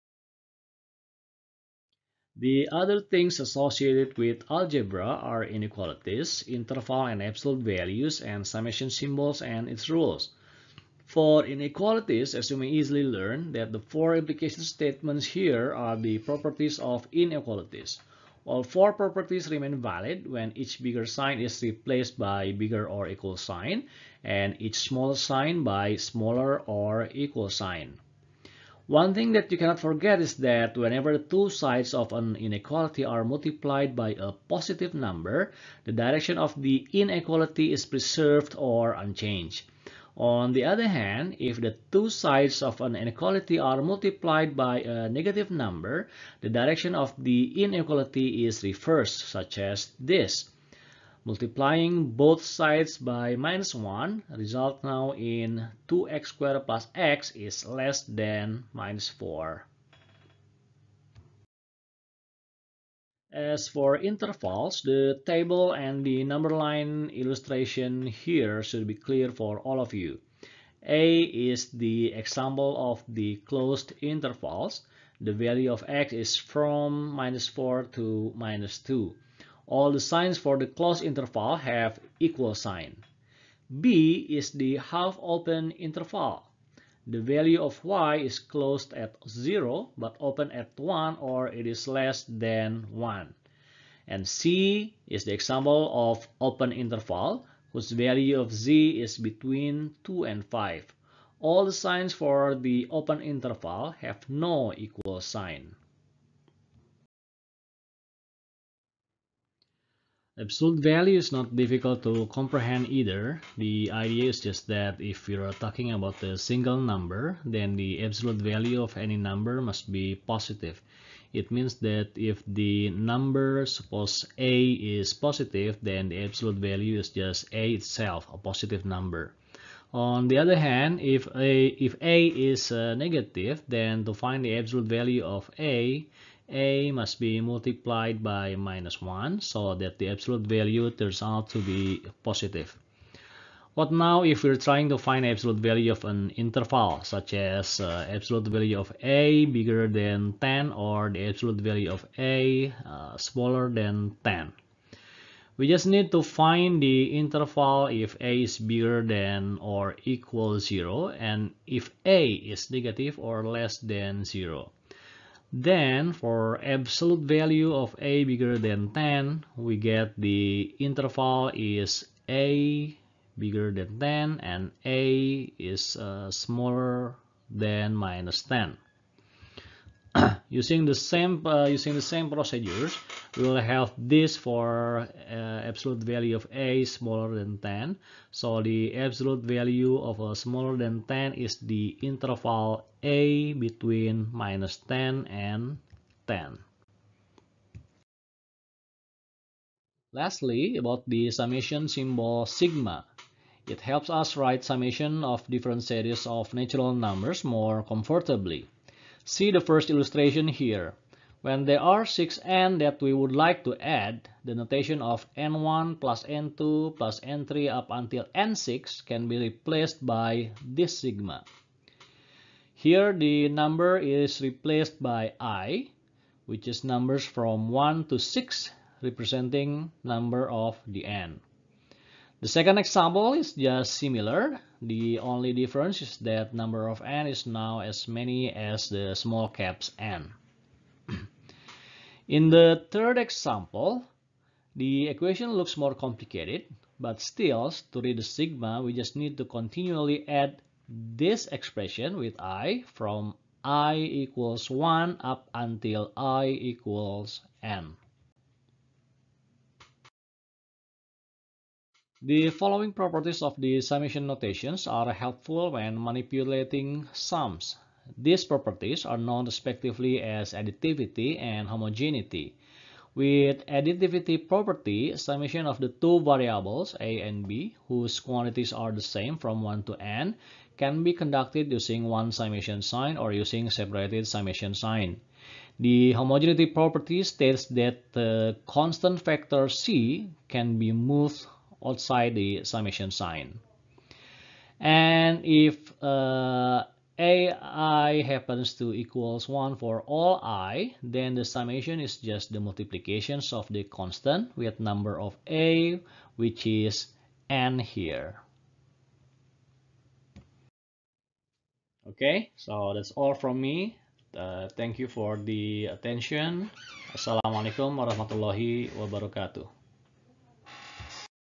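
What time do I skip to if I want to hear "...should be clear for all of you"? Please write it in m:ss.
1:08.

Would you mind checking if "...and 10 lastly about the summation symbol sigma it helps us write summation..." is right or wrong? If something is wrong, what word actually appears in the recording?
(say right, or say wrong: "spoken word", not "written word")
right.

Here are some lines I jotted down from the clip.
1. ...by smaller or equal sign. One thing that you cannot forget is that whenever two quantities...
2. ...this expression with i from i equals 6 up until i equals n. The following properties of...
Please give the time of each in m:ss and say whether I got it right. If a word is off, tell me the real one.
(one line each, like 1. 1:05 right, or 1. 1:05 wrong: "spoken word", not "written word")
1. 0:25 wrong: "sides", not "quantities"
2. 4:10 wrong: "1", not "6".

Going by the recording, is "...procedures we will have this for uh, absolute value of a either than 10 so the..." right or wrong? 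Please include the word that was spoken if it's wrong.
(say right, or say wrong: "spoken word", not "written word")
wrong: "smaller", not "either".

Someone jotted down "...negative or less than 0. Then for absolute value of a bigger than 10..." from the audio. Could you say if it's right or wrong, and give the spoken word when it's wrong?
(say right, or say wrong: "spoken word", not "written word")
right.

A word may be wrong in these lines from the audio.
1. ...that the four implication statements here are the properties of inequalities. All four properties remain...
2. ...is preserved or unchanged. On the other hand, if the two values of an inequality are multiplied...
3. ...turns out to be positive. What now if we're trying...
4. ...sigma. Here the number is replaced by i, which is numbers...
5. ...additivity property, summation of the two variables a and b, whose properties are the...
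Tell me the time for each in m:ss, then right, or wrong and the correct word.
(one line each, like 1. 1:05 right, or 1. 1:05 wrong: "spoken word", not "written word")
1. 0:13 right
2. 0:37 wrong: "sides", not "values"
3. 2:20 right
4. 3:40 right
5. 4:33 wrong: "quantities", not "properties".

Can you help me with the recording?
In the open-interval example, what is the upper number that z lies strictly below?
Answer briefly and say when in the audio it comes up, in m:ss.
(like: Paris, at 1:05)
5, at 1:40.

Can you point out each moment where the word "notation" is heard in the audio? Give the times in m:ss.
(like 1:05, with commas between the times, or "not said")
3:34, 4:24.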